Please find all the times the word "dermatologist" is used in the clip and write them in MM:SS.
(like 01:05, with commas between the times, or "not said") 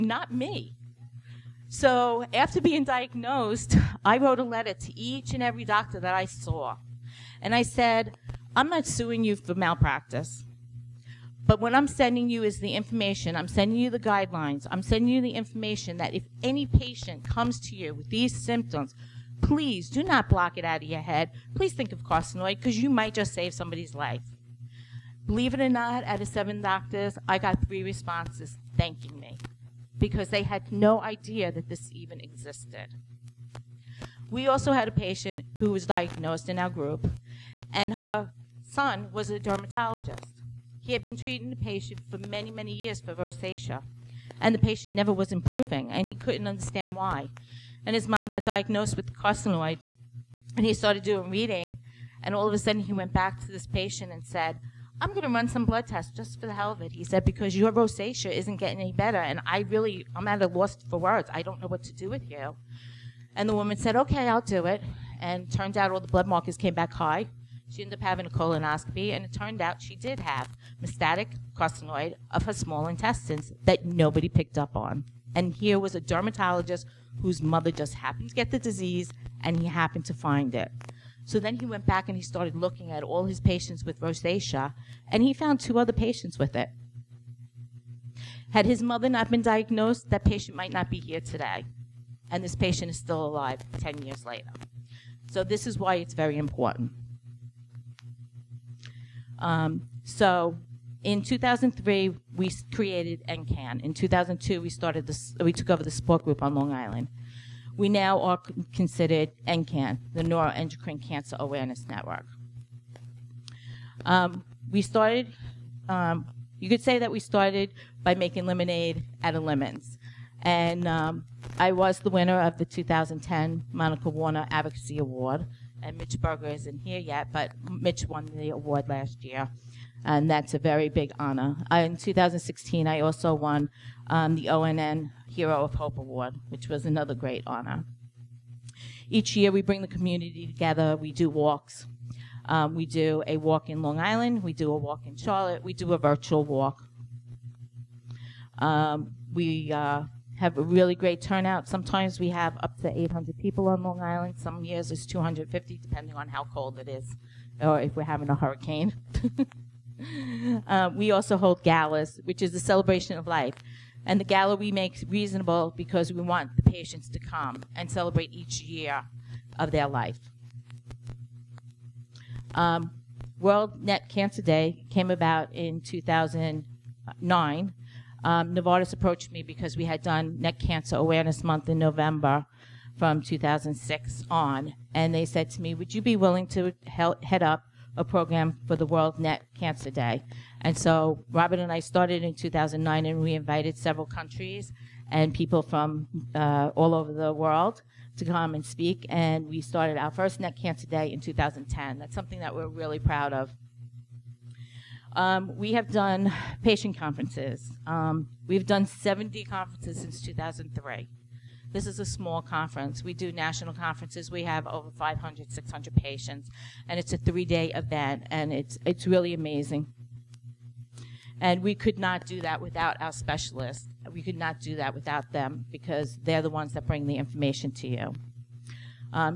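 00:39, 01:15.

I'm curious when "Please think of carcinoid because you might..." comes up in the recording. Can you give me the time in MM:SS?
00:21.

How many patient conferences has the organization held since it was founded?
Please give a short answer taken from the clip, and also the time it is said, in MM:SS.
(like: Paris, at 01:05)
70, at 03:28.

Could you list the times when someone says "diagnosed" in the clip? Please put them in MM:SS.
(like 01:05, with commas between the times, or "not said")
00:02, 00:35, 00:48, 01:29.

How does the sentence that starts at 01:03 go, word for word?
And the woman said, okay, I'll do it.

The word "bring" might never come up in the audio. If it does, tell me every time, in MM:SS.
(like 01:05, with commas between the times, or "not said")
02:19, 03:46.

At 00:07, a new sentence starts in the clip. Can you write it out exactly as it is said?
And I said, I'm not suing you for malpractice.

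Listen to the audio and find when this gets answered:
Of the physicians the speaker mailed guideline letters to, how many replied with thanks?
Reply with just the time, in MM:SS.
00:27.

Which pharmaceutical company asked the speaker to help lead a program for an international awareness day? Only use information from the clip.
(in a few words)
Novartis.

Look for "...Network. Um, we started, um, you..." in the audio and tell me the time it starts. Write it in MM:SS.
01:51.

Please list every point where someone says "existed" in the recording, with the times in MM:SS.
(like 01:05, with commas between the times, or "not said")
00:32.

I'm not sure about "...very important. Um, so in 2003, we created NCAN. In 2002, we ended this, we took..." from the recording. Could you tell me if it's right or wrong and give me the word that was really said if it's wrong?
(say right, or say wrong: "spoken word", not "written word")
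wrong: "started", not "ended".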